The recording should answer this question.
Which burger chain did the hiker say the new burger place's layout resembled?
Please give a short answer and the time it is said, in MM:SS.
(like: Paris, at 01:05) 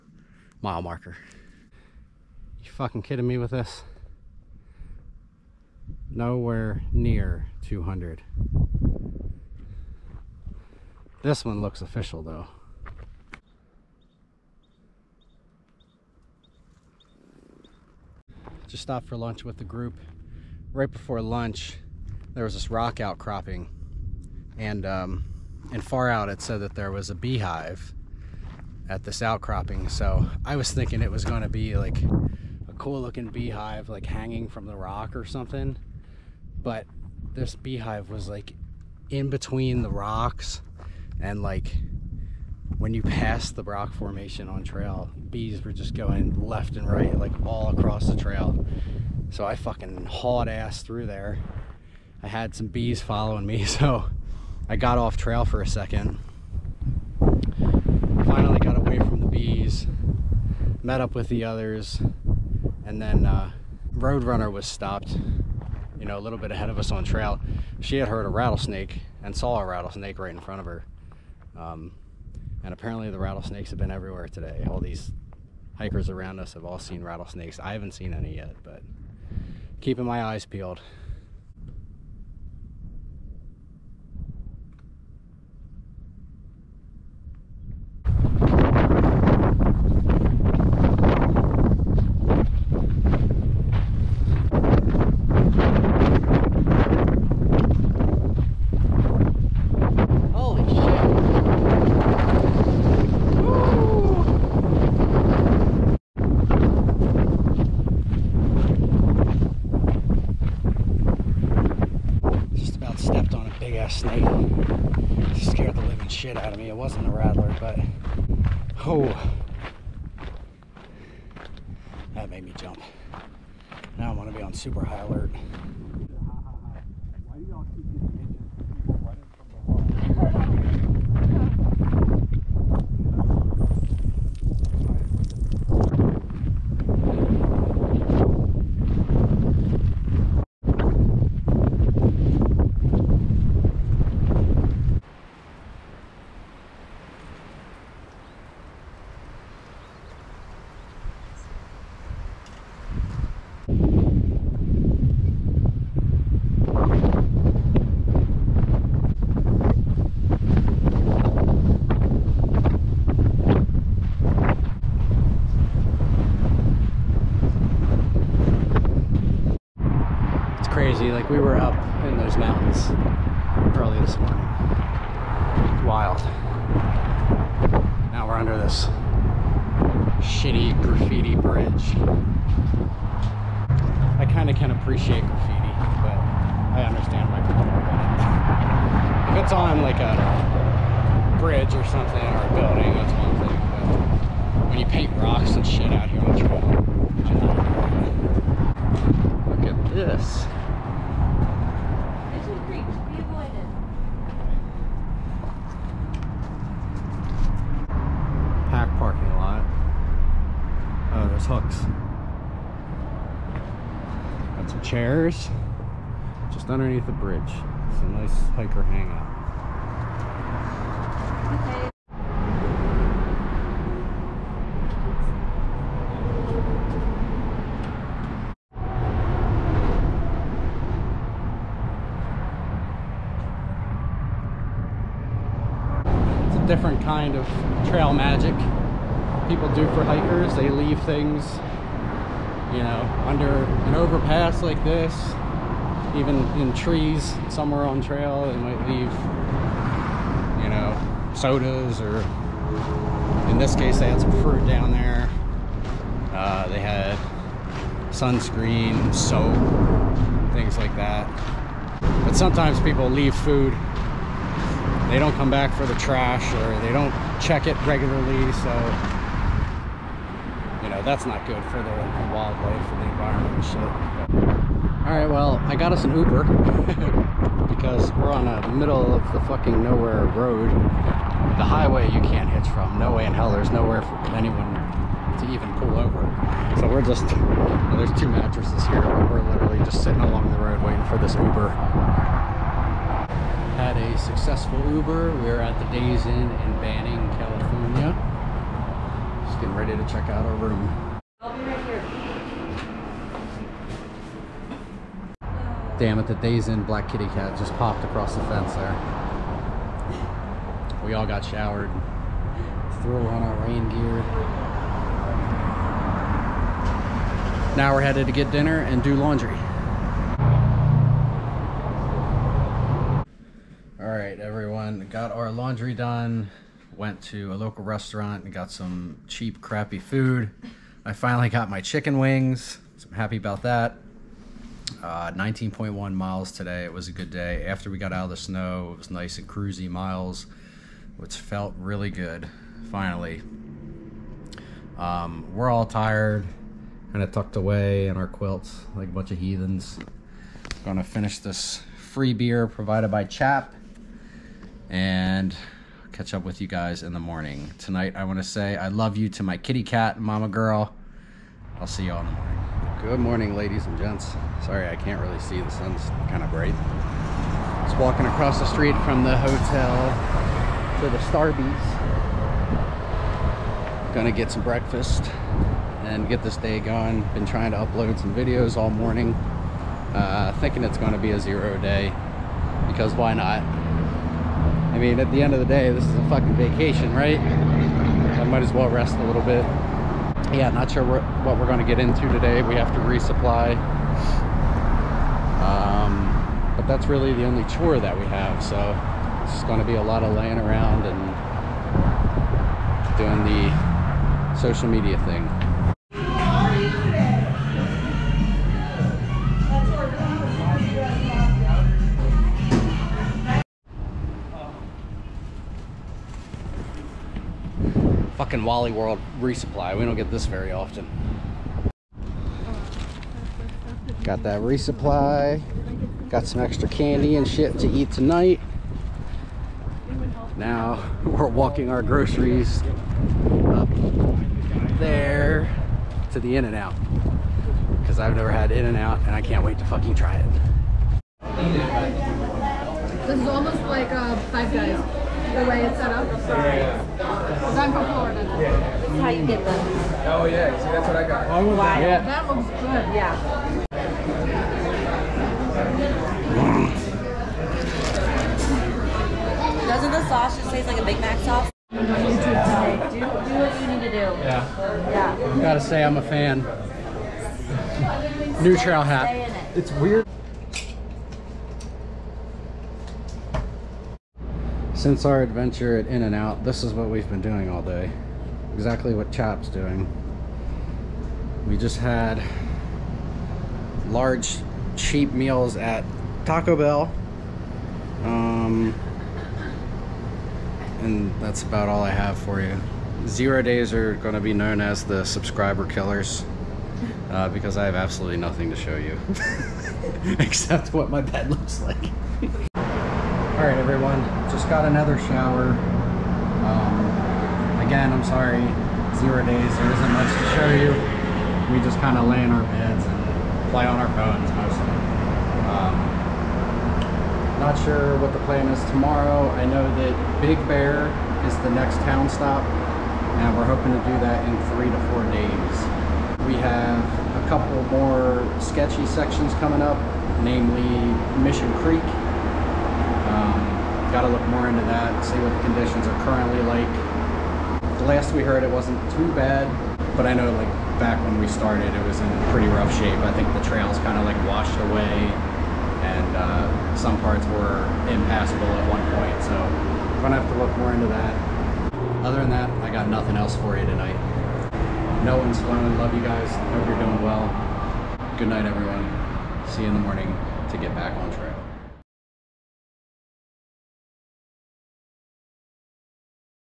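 Five Guys, at 07:24.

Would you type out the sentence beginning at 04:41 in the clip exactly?
The highway you can't hitch from.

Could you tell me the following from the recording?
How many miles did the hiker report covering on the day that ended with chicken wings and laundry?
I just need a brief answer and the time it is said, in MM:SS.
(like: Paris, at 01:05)
19.1, at 05:35.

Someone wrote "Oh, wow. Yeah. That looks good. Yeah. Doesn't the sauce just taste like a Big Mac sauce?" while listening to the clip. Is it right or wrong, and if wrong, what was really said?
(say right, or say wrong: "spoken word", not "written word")
right.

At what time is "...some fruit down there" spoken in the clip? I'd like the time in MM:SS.
04:14.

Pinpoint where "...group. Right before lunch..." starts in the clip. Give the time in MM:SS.
00:19.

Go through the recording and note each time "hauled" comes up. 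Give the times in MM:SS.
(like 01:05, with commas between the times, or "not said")
00:50.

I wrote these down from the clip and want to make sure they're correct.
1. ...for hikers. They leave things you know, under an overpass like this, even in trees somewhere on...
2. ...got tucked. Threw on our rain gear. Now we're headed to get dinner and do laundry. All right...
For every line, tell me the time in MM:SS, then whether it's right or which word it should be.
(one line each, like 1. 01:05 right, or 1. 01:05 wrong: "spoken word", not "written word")
1. 03:59 right
2. 05:11 wrong: "showered", not "tucked".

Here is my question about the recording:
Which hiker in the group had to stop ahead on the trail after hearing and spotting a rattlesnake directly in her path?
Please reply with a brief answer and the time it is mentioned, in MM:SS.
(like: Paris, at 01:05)
Roadrunner, at 01:03.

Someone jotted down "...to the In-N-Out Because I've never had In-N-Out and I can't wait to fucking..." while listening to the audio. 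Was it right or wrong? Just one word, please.
right.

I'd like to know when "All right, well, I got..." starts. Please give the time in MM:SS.
04:35.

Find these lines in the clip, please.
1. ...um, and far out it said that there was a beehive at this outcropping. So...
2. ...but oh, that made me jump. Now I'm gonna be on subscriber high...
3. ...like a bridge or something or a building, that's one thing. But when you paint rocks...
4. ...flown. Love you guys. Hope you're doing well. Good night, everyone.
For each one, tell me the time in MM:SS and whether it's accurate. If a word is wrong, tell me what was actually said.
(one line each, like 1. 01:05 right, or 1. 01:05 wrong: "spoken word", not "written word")
1. 00:24 right
2. 01:57 wrong: "super", not "subscriber"
3. 03:09 right
4. 09:15 right.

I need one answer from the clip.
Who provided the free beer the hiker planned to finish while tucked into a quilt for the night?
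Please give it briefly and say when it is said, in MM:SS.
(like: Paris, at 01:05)
Chap, at 05:53.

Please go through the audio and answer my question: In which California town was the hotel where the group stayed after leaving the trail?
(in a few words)
Banning.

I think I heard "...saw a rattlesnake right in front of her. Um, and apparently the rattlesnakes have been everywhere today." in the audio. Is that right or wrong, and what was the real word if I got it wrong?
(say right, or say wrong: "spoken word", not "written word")
right.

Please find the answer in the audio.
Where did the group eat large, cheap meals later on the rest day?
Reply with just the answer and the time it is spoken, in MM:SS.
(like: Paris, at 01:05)
Taco Bell, at 08:06.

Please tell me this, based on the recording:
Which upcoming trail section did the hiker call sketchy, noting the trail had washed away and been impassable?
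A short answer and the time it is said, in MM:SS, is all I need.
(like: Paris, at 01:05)
Mission Creek, at 08:51.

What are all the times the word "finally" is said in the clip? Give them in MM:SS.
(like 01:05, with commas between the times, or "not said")
00:58, 05:31, 05:42.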